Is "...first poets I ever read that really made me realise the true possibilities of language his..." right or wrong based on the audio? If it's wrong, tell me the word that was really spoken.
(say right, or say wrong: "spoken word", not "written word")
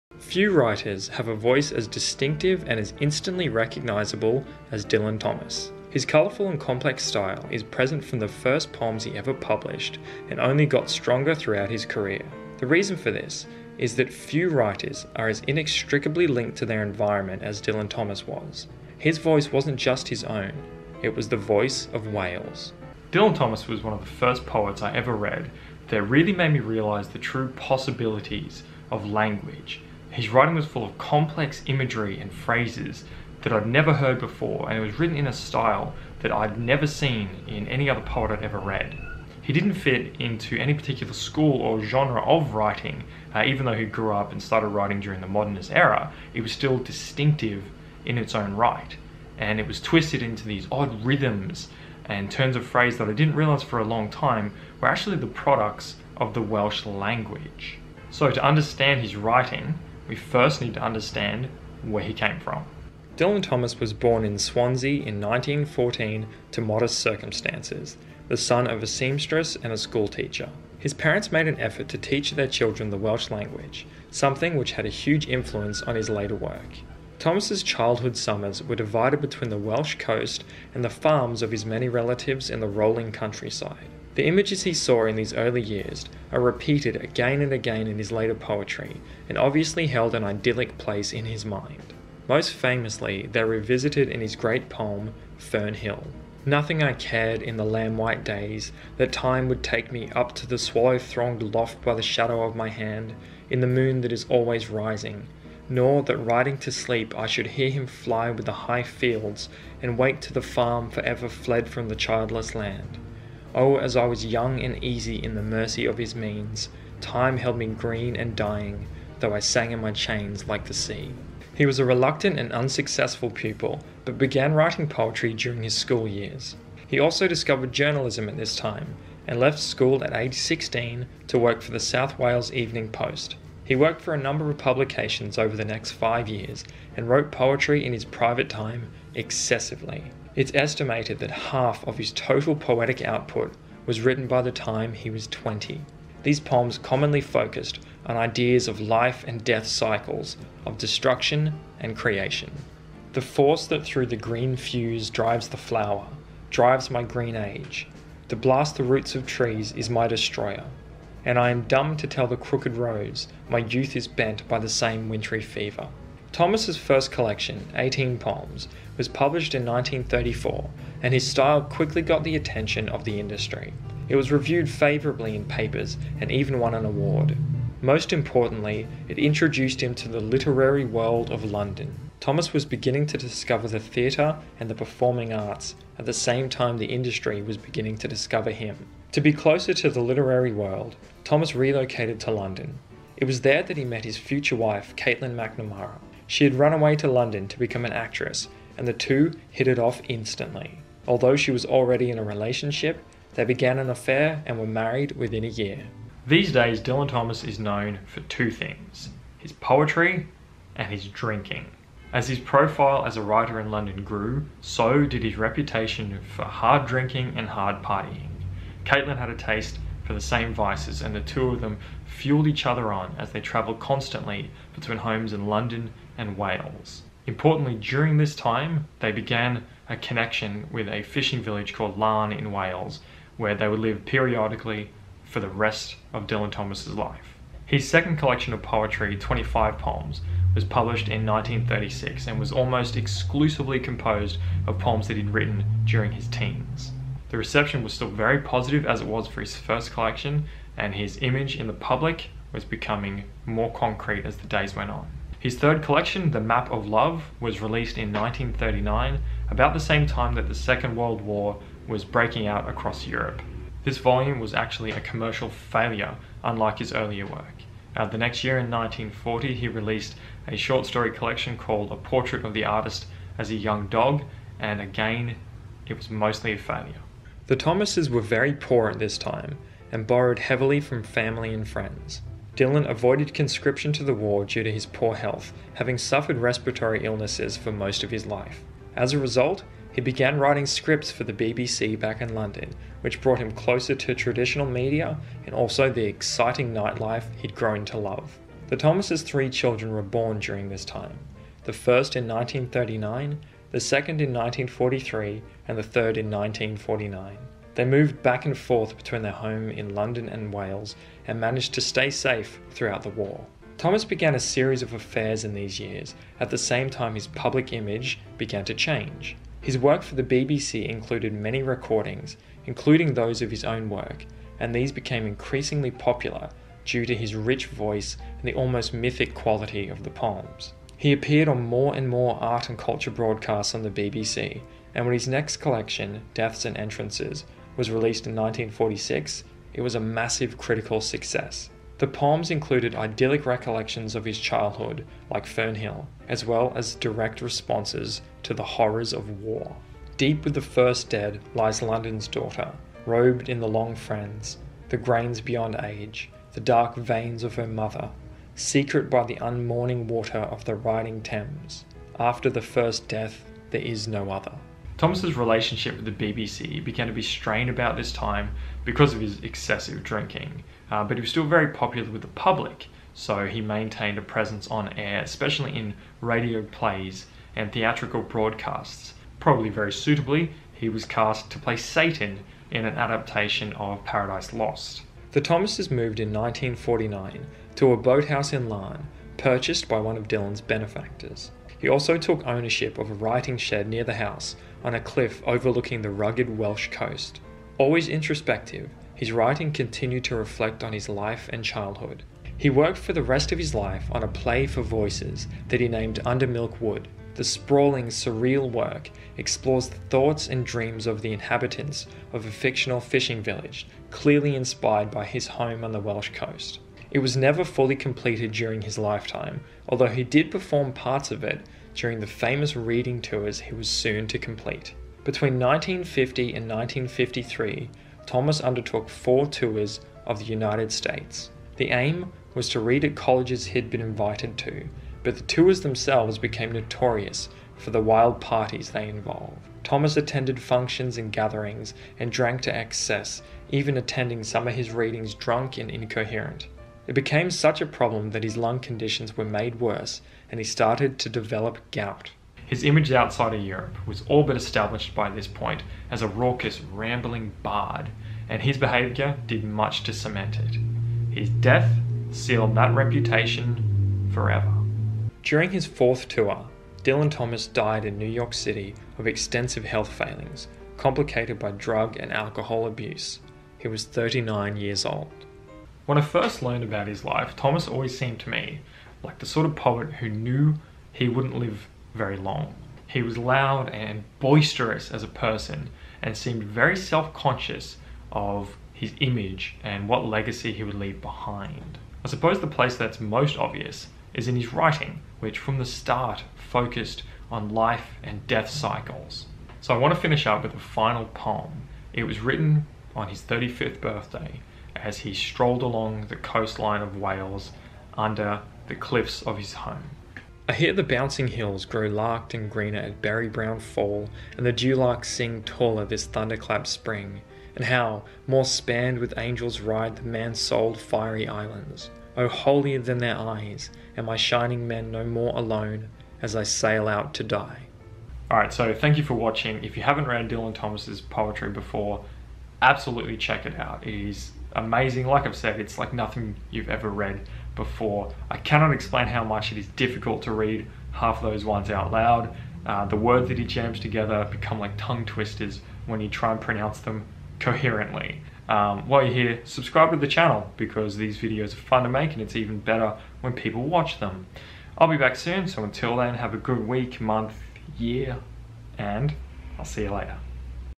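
right.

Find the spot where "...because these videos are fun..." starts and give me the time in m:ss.
9:10.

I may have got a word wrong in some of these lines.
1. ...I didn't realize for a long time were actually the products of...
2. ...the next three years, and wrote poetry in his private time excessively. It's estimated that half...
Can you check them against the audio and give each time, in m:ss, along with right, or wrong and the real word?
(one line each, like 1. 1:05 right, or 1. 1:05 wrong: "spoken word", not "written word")
1. 0:53 right
2. 2:15 wrong: "five", not "three".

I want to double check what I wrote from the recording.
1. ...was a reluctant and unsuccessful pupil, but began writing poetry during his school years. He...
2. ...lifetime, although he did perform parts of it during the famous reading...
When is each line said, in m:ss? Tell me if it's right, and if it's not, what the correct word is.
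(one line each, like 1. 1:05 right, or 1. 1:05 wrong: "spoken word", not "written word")
1. 2:01 right
2. 6:58 right.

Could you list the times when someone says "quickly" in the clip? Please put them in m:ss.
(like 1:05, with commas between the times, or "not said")
2:51.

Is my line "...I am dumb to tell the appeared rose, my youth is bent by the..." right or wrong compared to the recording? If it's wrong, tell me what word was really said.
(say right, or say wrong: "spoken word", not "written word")
wrong: "crooked", not "appeared".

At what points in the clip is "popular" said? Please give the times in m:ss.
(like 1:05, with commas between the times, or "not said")
5:25, 6:11.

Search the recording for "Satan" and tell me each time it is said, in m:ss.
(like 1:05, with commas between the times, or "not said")
6:21.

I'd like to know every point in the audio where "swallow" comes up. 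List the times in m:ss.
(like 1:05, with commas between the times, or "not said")
1:40.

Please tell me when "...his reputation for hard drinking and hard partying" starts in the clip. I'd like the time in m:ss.
3:35.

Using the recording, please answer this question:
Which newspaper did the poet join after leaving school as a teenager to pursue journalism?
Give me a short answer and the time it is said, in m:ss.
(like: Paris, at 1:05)
South Wales Evening Post, at 2:11.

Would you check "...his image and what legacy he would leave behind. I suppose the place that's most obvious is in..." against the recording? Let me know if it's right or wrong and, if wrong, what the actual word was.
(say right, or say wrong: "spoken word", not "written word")
right.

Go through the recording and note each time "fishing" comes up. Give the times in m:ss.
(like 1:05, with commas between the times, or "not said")
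3:51, 6:52.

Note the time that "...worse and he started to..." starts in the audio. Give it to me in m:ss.
7:29.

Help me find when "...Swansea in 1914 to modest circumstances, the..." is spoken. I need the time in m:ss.
1:04.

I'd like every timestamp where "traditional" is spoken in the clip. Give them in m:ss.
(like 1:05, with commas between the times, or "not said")
4:54.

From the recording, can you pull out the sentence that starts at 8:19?
So I want to finish up with a final poem.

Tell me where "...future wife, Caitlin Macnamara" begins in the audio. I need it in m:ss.
3:14.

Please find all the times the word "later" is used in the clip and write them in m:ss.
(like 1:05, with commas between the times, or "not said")
1:16, 1:28, 9:20.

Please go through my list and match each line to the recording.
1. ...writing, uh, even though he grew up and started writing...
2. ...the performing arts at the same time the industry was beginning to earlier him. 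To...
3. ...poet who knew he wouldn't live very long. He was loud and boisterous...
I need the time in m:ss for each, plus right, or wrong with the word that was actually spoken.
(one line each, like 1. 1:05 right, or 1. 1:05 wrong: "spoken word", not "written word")
1. 0:42 right
2. 3:04 wrong: "discover", not "earlier"
3. 7:59 right.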